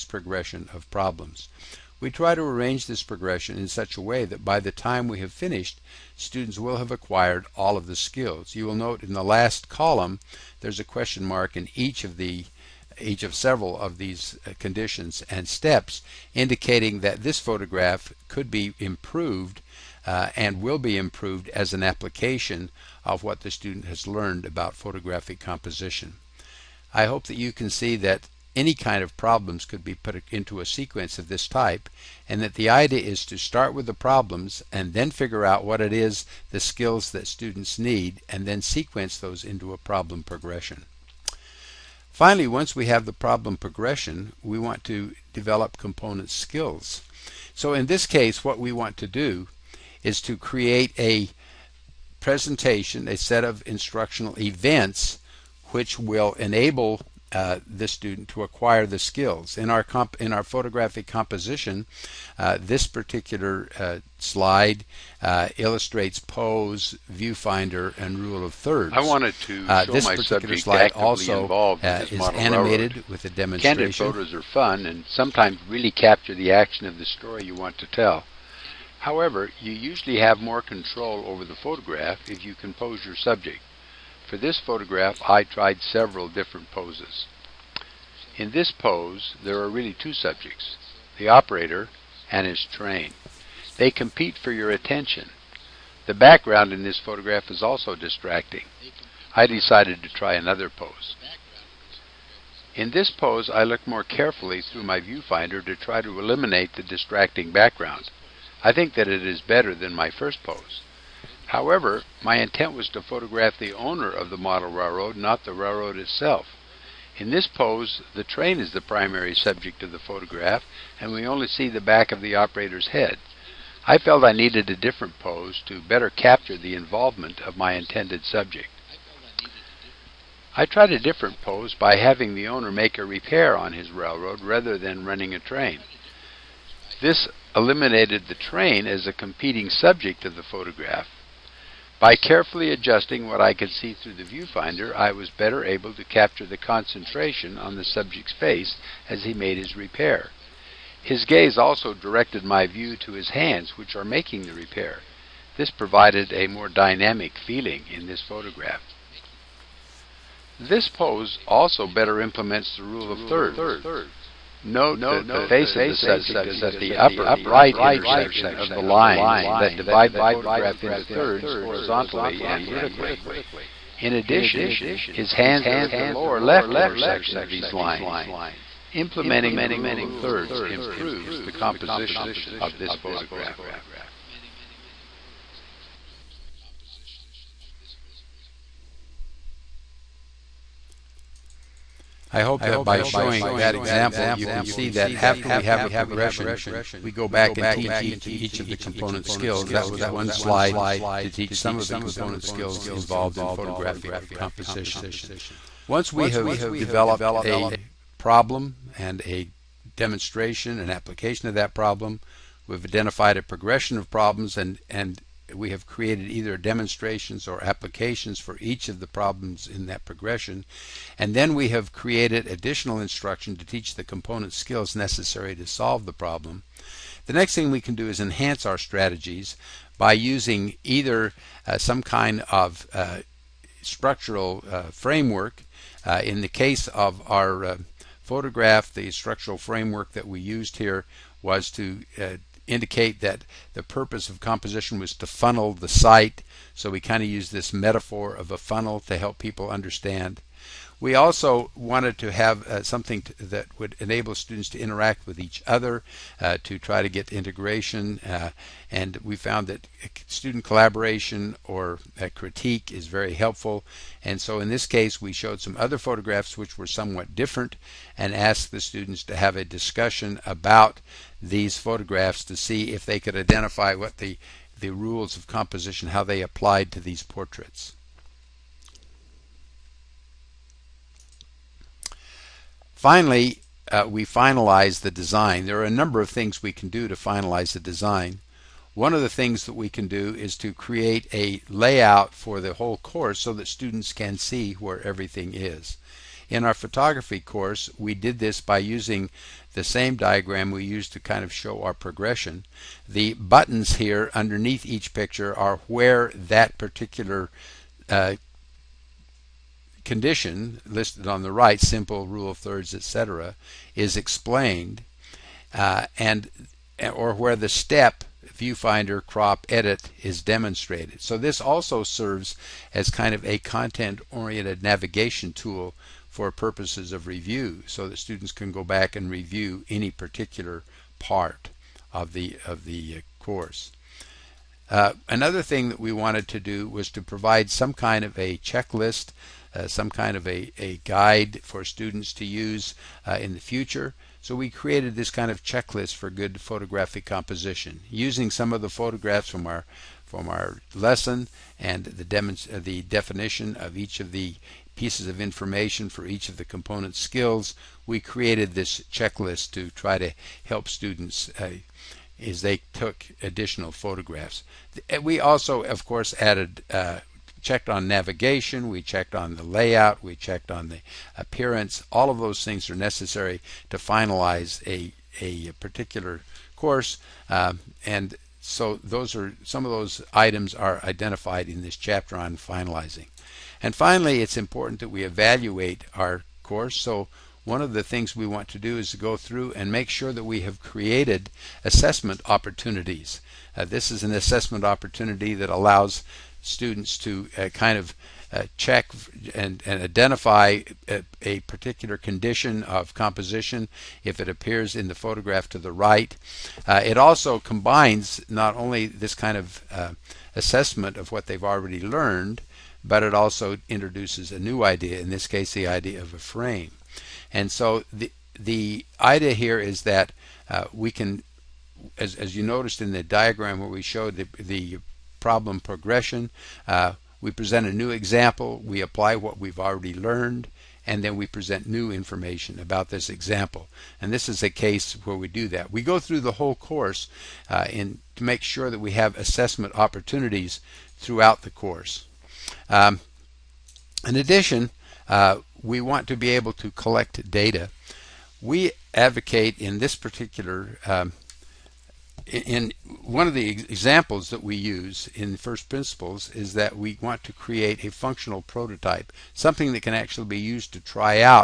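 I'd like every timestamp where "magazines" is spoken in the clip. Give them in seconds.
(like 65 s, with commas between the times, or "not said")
not said.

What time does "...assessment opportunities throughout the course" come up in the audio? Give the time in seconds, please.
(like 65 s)
439 s.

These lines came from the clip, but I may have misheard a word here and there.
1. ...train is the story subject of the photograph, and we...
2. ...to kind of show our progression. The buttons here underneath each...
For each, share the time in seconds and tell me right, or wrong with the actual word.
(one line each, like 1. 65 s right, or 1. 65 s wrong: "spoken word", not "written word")
1. 118 s wrong: "primary", not "story"
2. 301 s right.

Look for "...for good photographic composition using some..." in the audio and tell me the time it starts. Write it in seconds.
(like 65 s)
346 s.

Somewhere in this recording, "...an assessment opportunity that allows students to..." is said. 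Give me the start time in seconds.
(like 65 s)
394 s.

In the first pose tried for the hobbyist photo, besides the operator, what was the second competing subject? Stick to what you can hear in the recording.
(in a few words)
his train.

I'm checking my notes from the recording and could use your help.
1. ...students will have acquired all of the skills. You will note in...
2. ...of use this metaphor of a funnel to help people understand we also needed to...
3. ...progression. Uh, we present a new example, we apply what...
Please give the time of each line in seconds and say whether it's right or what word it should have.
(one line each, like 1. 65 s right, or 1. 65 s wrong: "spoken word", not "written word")
1. 6 s right
2. 247 s wrong: "wanted", not "needed"
3. 425 s right.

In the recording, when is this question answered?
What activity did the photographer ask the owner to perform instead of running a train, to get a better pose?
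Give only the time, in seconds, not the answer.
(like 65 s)
132 s.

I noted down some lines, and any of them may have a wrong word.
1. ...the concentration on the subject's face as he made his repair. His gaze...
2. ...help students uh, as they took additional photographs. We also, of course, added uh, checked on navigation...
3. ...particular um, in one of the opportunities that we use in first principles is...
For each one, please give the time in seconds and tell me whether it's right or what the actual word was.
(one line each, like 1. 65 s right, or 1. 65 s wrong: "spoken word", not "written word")
1. 146 s right
2. 360 s right
3. 450 s wrong: "examples", not "opportunities".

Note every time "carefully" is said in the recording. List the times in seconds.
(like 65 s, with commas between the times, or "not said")
104 s, 142 s.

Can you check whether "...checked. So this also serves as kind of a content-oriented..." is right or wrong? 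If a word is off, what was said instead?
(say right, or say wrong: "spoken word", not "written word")
wrong: "demonstrated", not "checked".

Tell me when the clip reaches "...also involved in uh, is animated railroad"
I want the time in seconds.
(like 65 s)
70 s.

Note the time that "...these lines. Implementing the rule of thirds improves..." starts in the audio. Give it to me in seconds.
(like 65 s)
177 s.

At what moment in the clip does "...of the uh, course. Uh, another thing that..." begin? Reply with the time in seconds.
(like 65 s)
332 s.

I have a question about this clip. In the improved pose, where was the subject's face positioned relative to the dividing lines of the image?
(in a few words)
upper right intersection.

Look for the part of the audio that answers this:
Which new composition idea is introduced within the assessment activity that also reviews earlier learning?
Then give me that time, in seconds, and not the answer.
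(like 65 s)
416 s.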